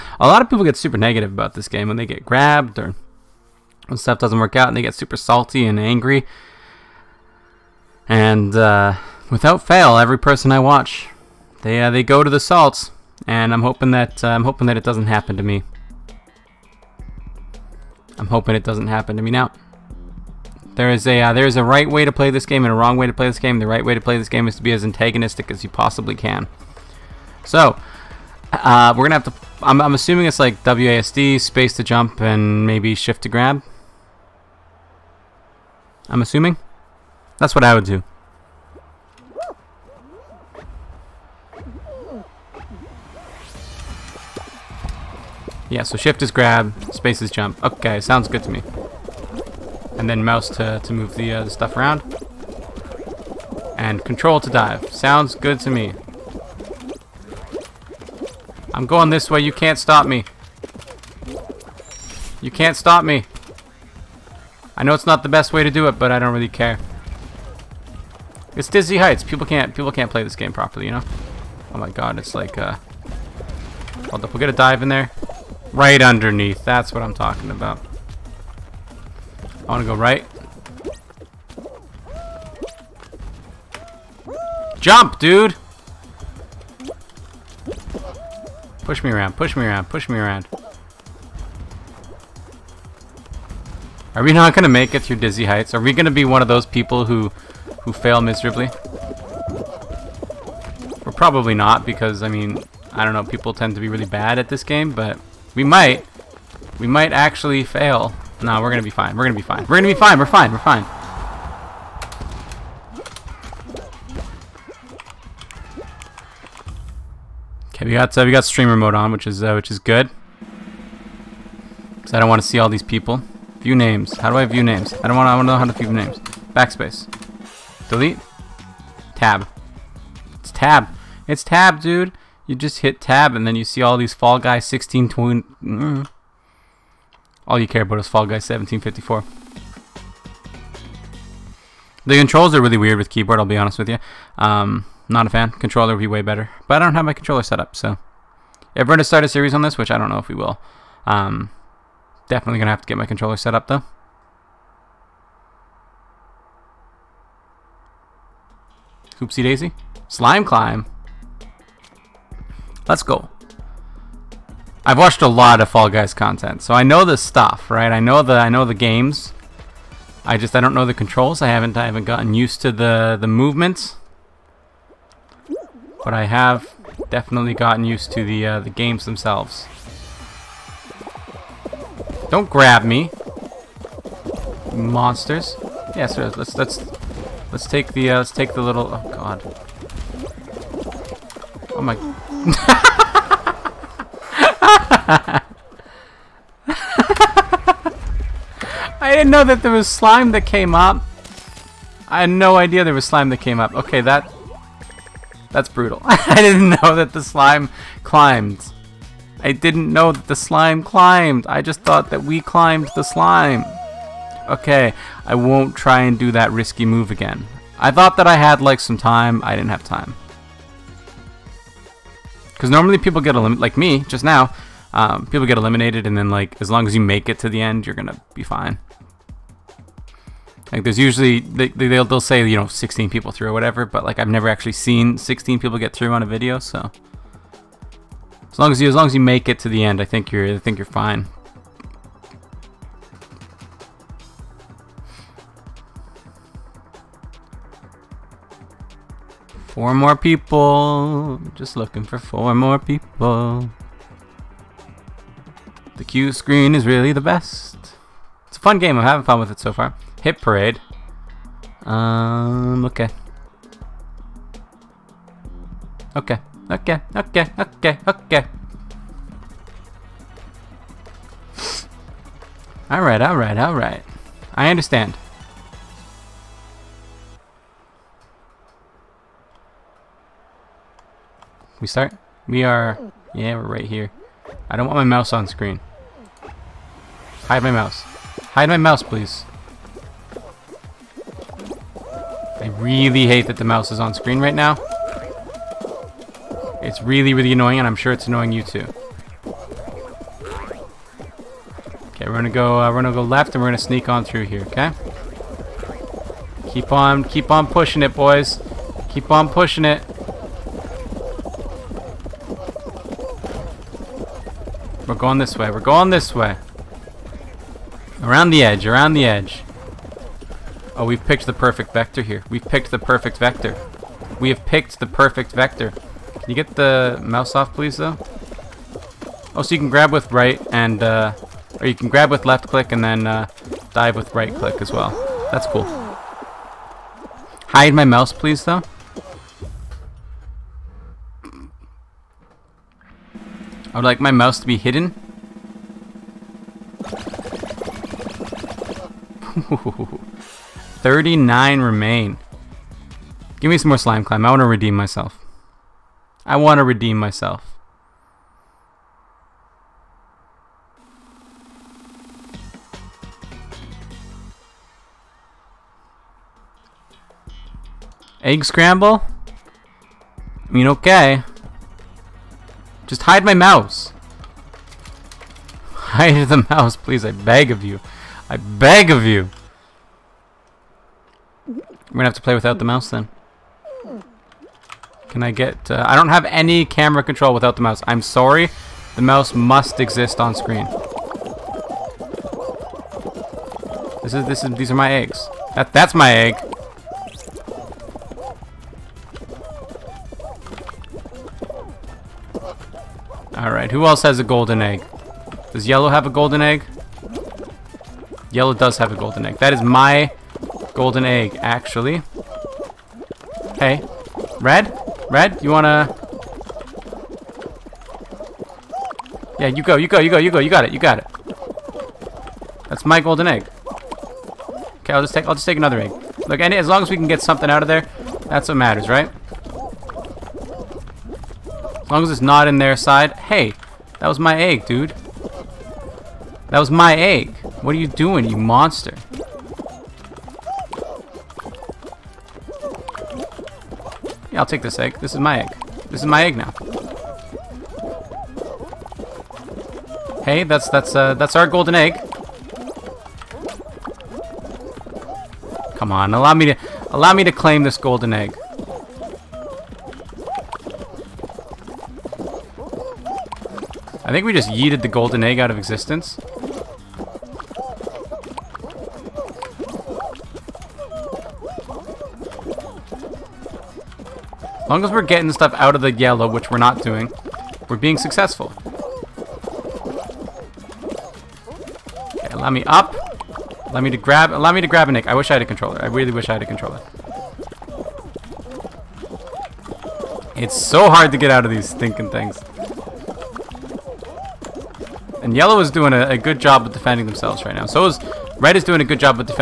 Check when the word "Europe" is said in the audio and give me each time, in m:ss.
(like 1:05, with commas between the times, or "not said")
not said.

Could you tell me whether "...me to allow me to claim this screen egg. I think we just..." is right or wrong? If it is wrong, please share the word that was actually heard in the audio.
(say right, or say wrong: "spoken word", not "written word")
wrong: "golden", not "screen".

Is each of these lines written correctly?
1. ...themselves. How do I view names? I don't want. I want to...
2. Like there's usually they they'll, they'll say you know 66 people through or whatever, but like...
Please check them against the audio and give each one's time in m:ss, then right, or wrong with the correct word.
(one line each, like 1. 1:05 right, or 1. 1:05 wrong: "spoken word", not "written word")
1. 2:03 wrong: "names", not "themselves"
2. 3:50 wrong: "16", not "66".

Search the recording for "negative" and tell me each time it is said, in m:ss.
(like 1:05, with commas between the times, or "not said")
0:00.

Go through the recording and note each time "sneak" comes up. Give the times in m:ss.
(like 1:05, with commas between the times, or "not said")
5:03.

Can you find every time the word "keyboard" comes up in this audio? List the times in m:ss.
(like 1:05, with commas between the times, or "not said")
2:23.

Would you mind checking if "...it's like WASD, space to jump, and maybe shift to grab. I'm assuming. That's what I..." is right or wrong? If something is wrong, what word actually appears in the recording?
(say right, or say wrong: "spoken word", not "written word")
right.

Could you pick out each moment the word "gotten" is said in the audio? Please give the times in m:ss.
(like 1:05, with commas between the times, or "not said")
2:52, 2:57.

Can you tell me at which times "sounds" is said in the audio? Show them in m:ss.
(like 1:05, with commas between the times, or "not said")
0:48, 0:54.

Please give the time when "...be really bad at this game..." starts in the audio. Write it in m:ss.
1:43.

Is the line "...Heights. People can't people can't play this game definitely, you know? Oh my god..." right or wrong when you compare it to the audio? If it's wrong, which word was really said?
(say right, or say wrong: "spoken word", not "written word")
wrong: "properly", not "definitely".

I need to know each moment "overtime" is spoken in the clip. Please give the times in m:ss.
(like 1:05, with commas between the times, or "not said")
not said.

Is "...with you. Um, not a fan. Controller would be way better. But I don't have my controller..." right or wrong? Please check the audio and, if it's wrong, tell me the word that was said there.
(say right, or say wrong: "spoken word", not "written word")
right.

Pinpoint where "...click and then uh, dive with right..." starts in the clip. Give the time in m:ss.
5:32.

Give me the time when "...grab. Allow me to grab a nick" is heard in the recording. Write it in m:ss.
8:04.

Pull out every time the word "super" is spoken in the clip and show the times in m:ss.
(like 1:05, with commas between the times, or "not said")
0:00, 0:04.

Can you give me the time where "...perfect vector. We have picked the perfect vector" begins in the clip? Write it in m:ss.
5:22.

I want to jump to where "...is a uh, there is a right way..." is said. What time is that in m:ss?
0:20.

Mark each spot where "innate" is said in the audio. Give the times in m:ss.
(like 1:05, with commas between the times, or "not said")
not said.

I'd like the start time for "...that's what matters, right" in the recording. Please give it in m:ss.
7:08.